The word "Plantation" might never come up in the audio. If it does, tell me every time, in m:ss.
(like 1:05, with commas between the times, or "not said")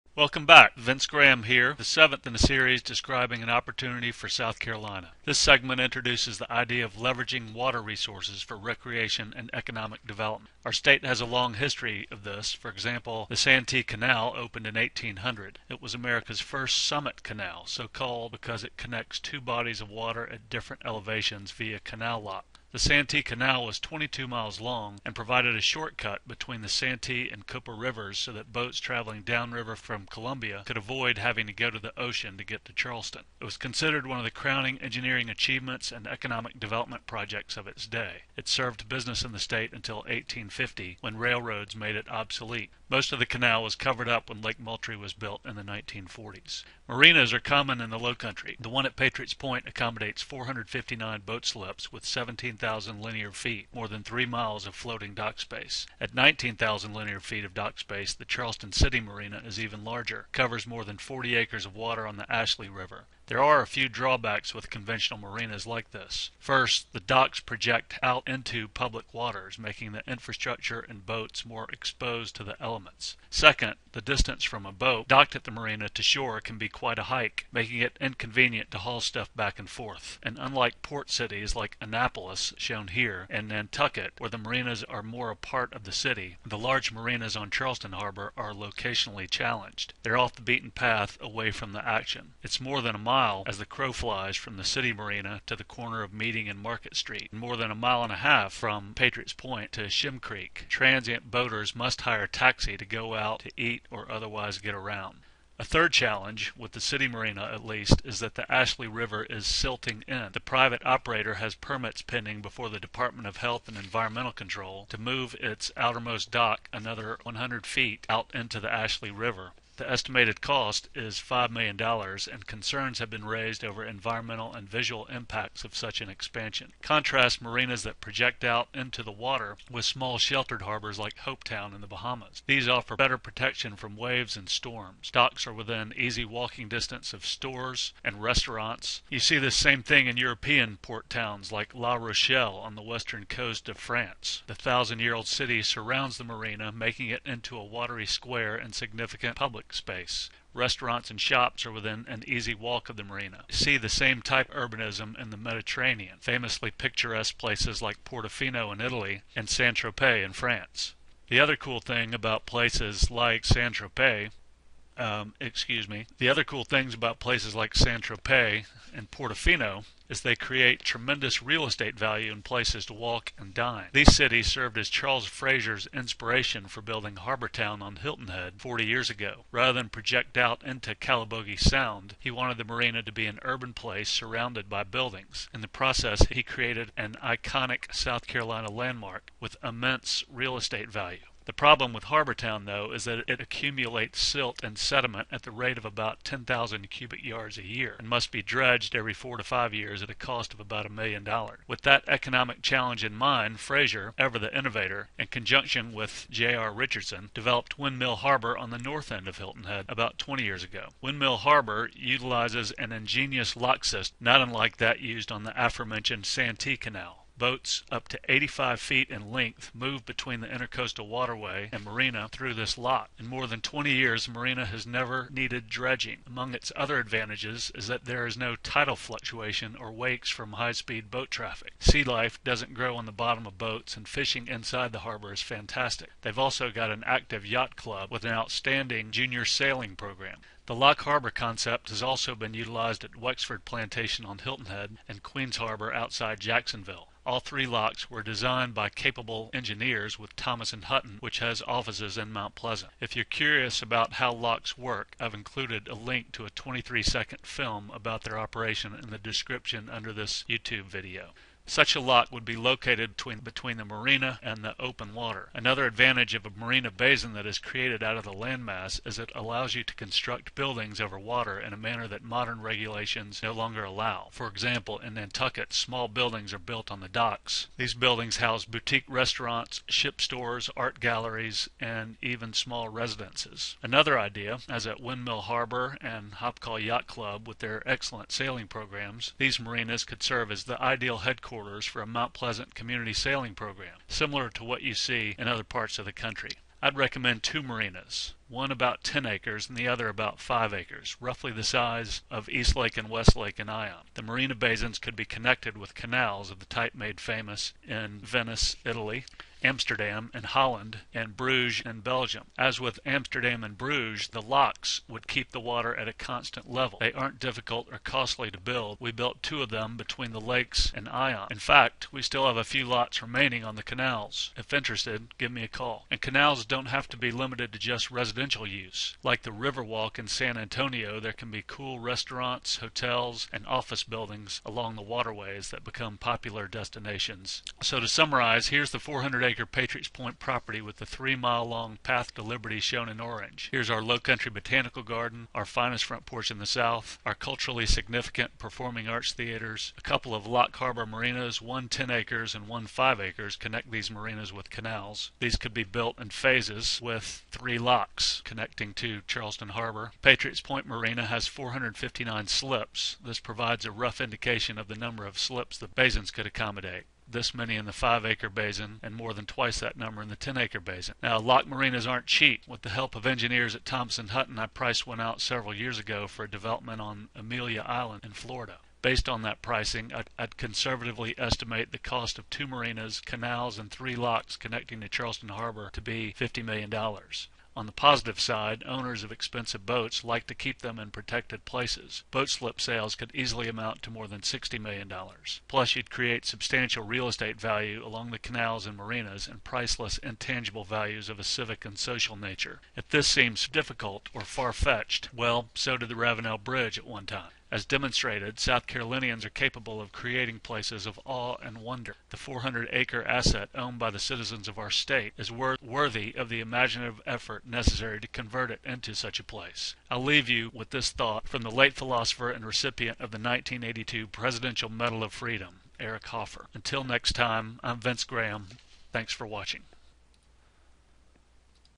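4:03.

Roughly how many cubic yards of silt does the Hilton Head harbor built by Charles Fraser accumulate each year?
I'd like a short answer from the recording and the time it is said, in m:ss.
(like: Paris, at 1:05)
10,000, at 3:16.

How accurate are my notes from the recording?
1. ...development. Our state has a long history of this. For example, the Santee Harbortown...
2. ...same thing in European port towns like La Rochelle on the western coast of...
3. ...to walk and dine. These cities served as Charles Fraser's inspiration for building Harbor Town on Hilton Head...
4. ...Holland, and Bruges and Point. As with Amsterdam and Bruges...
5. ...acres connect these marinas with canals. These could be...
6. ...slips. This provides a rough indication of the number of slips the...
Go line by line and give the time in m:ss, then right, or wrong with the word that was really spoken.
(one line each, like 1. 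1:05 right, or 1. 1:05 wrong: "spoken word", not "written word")
1. 0:10 wrong: "Canal", not "Harbortown"
2. 2:19 right
3. 2:52 right
4. 5:10 wrong: "Belgium", not "Point"
5. 5:53 right
6. 6:02 right.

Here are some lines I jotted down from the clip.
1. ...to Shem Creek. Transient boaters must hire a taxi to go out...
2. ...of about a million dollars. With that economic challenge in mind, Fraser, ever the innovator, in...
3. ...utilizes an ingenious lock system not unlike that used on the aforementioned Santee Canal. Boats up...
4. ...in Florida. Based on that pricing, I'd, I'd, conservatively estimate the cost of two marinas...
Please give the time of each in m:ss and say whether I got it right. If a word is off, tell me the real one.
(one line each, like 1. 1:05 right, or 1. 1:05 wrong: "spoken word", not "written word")
1. 1:39 right
2. 3:20 right
3. 3:31 right
4. 6:18 right.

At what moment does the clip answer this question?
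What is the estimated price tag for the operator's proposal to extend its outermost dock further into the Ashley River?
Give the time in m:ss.
2:01.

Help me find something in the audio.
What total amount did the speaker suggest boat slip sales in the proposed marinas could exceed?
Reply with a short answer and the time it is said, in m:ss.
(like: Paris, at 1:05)
$60 million, at 6:34.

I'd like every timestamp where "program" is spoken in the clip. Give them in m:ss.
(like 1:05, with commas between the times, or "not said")
3:59, 4:48, 4:53.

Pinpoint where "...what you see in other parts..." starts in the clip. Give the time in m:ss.
4:54.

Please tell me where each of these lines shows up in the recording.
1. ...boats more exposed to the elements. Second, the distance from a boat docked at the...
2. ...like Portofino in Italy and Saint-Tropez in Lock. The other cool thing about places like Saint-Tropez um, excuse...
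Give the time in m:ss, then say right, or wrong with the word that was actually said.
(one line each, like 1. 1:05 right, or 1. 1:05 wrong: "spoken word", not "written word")
1. 1:11 right
2. 2:37 wrong: "France", not "Lock".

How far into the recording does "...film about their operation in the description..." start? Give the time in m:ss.
4:17.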